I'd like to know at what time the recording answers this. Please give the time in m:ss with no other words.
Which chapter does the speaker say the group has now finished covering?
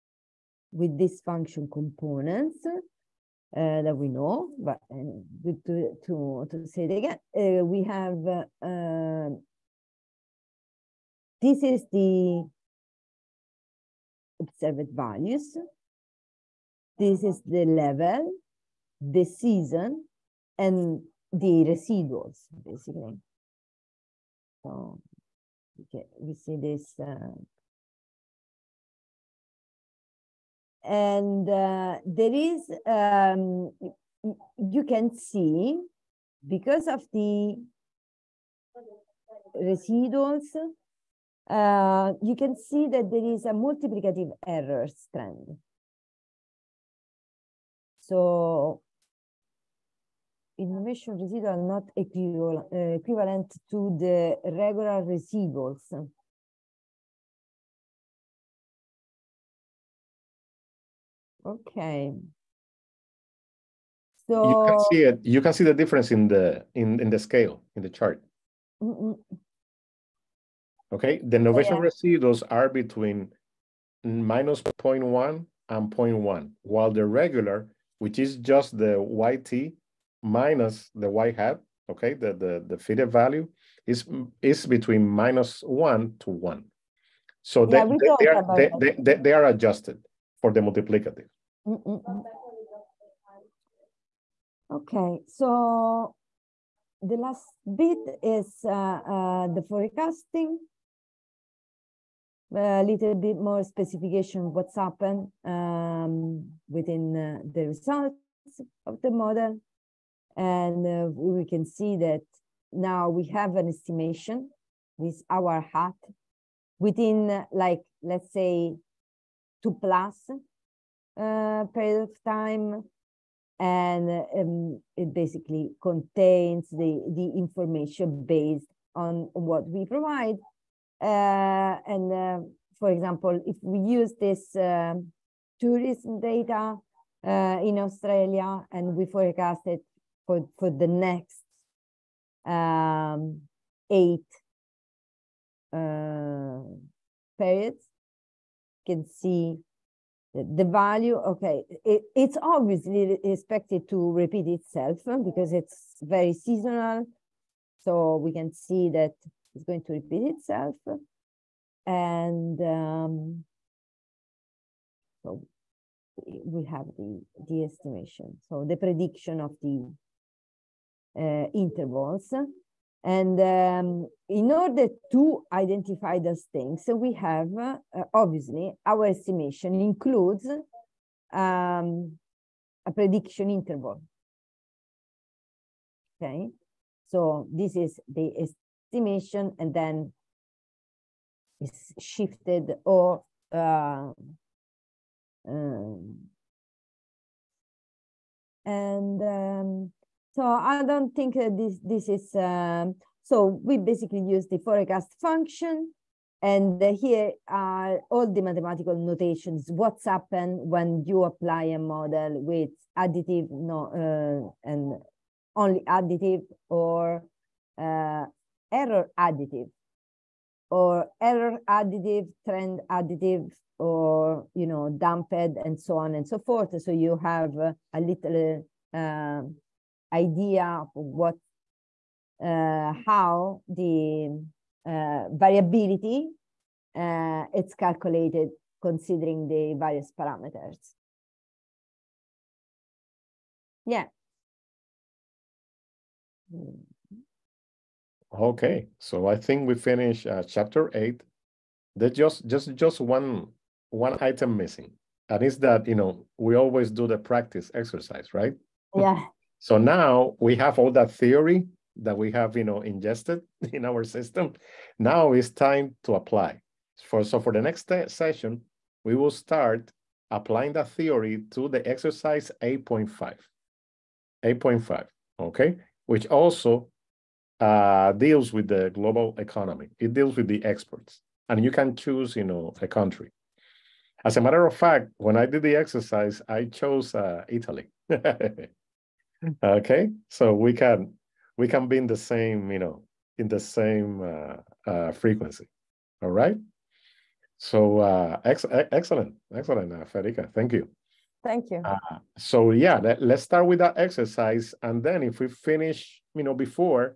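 4:10.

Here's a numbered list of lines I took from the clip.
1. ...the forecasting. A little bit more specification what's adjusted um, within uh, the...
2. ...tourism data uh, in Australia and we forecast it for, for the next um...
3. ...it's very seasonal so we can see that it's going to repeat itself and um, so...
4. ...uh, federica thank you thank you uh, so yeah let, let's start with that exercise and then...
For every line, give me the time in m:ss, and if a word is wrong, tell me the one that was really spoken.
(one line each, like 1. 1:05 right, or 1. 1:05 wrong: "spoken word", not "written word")
1. 1:39 wrong: "happened", not "adjusted"
2. 2:15 right
3. 2:35 right
4. 4:59 right.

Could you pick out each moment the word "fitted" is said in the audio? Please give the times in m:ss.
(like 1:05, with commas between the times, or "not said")
1:22.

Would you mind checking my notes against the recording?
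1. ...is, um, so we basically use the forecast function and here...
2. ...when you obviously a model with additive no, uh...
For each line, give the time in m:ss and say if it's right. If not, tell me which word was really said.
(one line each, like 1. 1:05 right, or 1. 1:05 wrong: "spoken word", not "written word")
1. 3:22 right
2. 3:30 wrong: "apply", not "obviously".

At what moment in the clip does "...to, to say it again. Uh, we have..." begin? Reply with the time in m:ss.
0:06.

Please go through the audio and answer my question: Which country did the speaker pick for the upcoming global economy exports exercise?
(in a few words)
Italy.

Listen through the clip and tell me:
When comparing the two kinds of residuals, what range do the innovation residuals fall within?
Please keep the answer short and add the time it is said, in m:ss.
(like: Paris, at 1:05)
-0.1 to 0.1, at 1:14.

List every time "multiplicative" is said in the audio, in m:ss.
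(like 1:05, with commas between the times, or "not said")
0:43, 1:30.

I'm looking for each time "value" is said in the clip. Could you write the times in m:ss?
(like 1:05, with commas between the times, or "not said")
0:14, 1:23, 2:30.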